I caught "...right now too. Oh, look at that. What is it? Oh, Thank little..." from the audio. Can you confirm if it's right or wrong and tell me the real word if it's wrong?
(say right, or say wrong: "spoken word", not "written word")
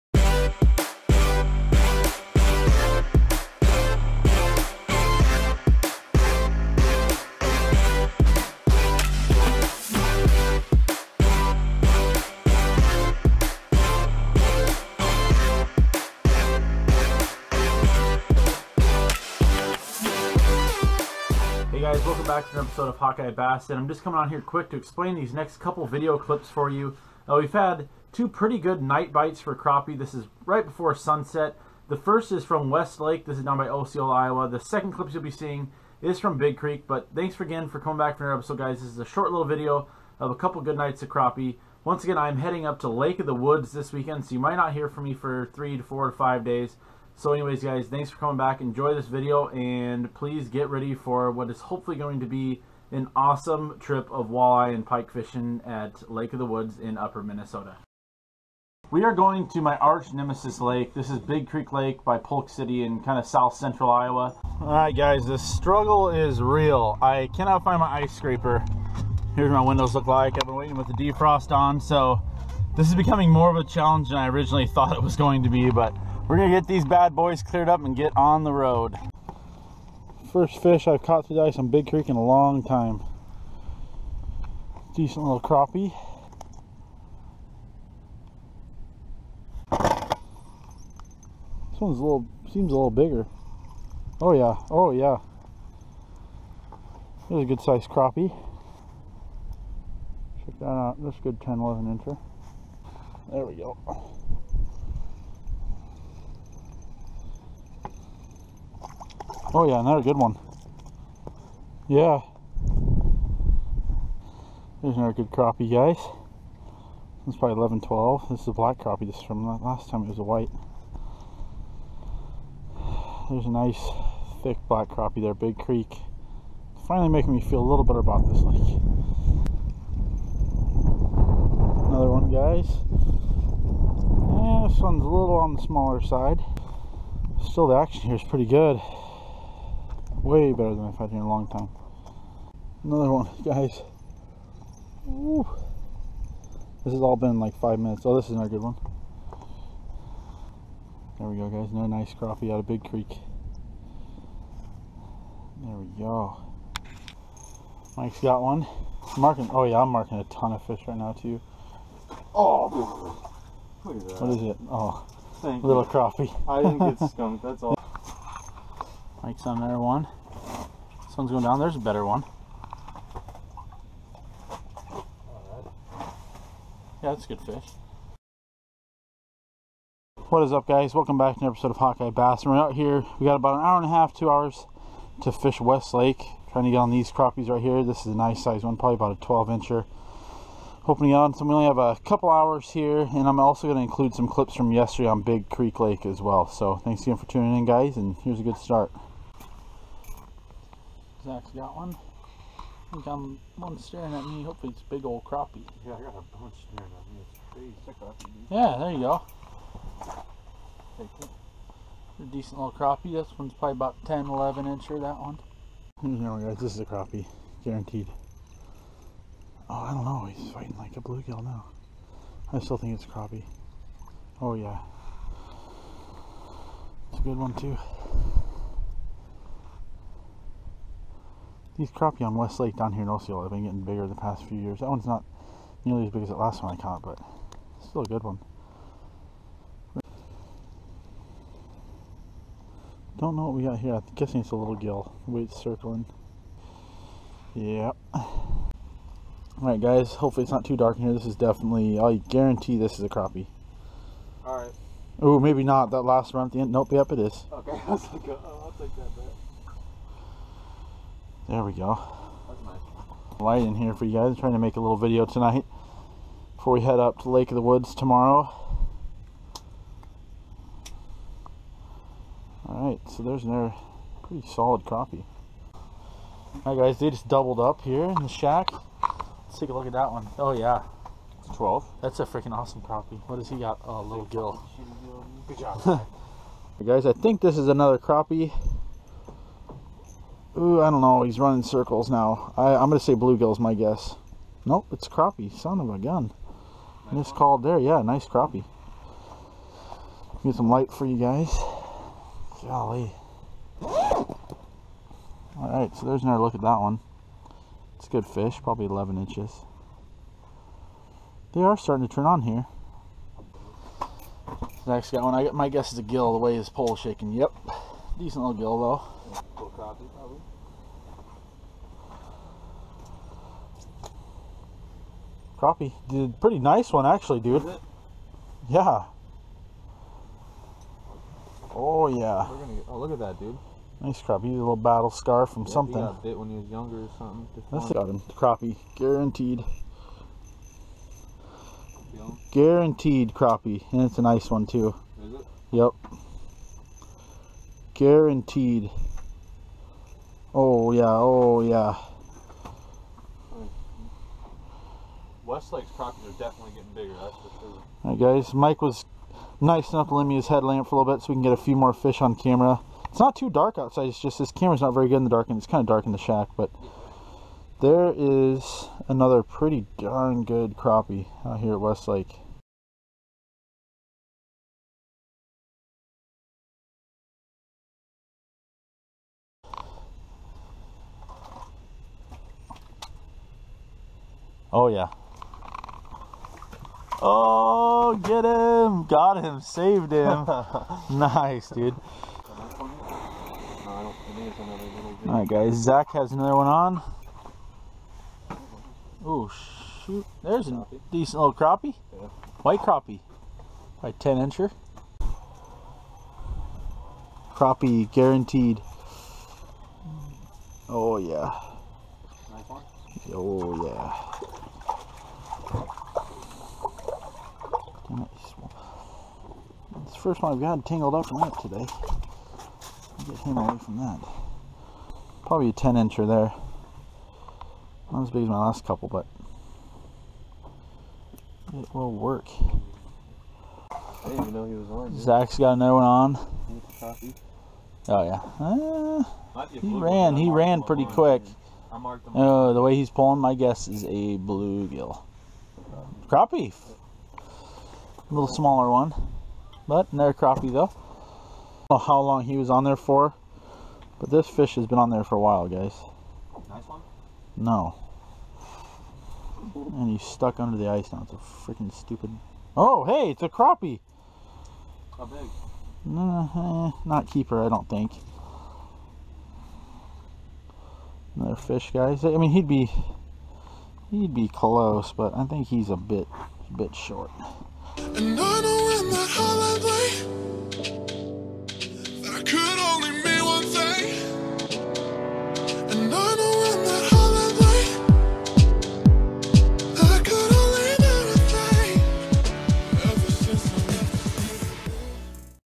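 right.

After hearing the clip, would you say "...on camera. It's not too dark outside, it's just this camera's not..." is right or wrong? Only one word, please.
right.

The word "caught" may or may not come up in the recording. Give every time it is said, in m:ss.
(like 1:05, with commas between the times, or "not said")
1:21, 3:56.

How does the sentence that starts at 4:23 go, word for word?
Light in here for you guys.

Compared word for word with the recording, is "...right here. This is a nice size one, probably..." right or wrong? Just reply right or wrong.
right.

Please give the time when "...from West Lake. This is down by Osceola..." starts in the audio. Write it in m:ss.
0:32.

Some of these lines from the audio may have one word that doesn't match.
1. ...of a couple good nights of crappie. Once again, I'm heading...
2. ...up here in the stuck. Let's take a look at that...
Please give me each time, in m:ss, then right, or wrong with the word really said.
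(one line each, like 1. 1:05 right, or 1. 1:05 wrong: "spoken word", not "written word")
1. 0:40 right
2. 4:37 wrong: "shack", not "stuck".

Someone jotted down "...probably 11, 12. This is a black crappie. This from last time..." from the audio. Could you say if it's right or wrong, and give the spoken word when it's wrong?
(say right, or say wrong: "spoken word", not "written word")
right.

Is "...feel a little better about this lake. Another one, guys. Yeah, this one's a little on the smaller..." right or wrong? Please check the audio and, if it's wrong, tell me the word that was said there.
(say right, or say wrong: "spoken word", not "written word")
right.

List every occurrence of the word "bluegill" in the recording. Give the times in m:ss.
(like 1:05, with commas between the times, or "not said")
3:41, 4:53, 7:24.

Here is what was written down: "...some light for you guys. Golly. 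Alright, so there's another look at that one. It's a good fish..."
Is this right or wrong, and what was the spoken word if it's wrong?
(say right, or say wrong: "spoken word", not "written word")
right.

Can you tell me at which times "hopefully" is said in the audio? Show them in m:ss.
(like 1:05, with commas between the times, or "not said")
0:51, 3:24, 4:10.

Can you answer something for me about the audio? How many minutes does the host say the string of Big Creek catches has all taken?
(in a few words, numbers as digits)
5.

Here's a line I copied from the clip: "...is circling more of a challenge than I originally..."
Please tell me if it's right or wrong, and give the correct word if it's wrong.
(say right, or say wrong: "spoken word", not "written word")
wrong: "becoming", not "circling".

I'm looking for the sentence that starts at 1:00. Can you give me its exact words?
This is Big Creek Lake by Polk City in kind of south central Iowa.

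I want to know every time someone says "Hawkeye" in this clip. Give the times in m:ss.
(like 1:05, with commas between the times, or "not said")
0:22, 3:01.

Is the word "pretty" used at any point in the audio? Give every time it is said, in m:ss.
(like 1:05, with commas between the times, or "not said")
0:28, 2:18, 4:34, 5:26, 6:09, 7:20.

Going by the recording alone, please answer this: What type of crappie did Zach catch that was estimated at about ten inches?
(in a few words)
White crappie.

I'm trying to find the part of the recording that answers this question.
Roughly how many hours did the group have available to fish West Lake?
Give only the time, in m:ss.
3:03.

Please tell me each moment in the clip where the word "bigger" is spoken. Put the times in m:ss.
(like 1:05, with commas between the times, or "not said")
1:32, 3:53, 5:56.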